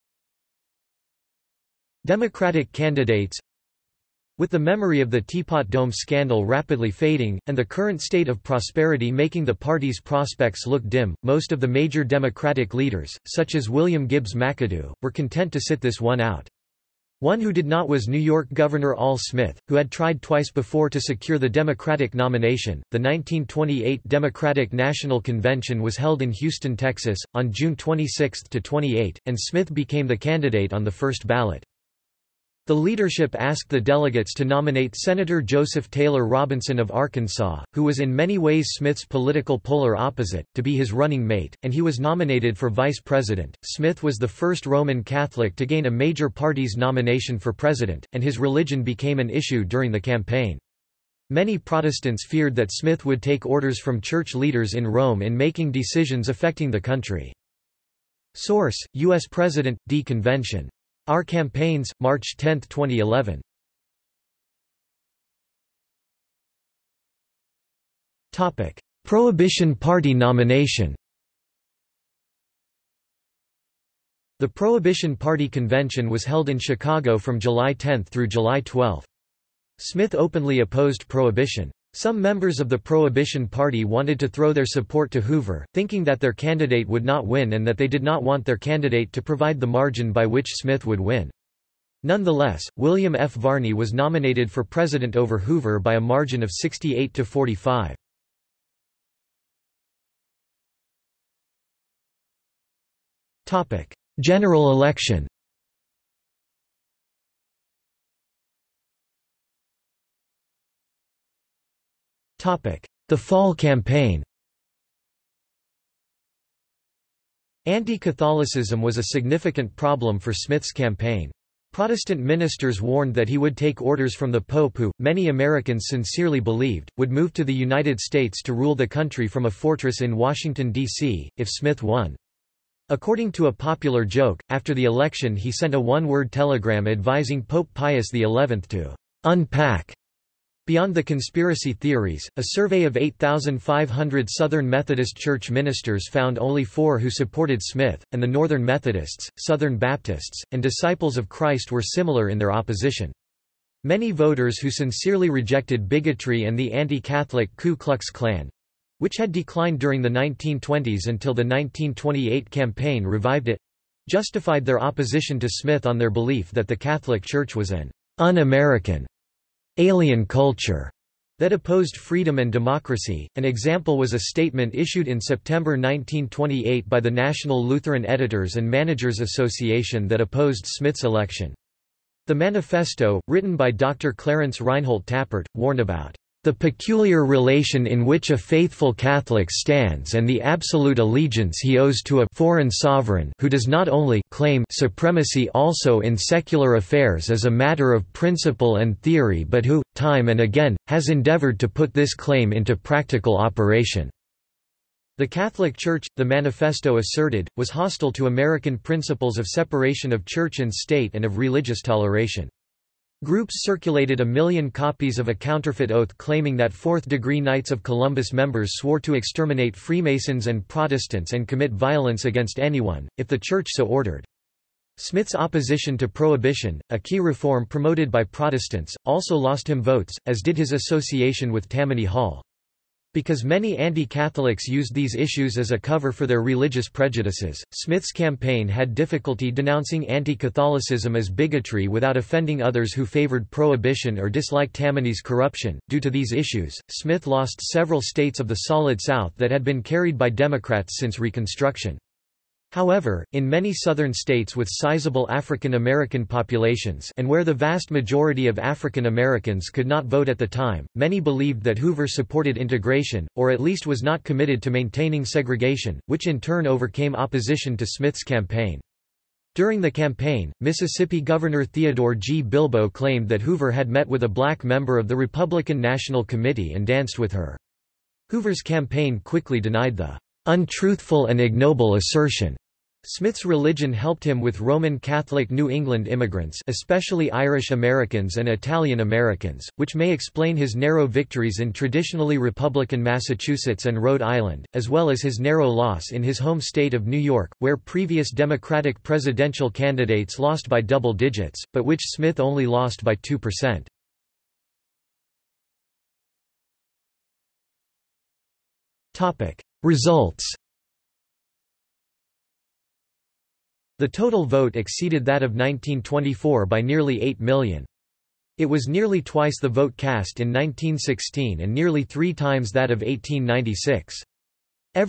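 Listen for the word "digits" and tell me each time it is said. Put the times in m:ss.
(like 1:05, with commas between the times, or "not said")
5:01.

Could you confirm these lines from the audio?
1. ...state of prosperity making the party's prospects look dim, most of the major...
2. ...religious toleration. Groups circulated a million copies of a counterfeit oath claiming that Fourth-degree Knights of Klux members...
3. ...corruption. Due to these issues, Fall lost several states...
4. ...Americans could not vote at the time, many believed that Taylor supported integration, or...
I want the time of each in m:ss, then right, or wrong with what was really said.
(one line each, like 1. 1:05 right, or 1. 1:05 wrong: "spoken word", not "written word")
1. 0:08 right
2. 3:31 wrong: "Columbus", not "Klux"
3. 4:05 wrong: "Smith", not "Fall"
4. 4:19 wrong: "Hoover", not "Taylor".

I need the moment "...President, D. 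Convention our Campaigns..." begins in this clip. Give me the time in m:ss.
0:59.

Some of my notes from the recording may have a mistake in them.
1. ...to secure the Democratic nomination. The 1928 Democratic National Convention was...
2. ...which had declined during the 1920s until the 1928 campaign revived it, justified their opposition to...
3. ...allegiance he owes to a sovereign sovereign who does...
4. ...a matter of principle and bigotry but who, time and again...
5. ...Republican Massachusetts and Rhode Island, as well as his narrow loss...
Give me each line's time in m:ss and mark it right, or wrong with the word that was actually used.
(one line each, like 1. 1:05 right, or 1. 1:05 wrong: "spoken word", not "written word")
1. 0:20 right
2. 2:38 right
3. 3:10 wrong: "foreign", not "sovereign"
4. 3:17 wrong: "theory", not "bigotry"
5. 4:52 right.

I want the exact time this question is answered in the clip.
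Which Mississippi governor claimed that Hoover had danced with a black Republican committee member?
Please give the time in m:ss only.
4:31.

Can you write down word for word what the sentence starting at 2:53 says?
An example was a statement issued in September 1928 by the National Lutheran Editors and Managers Association that opposed Smith's election.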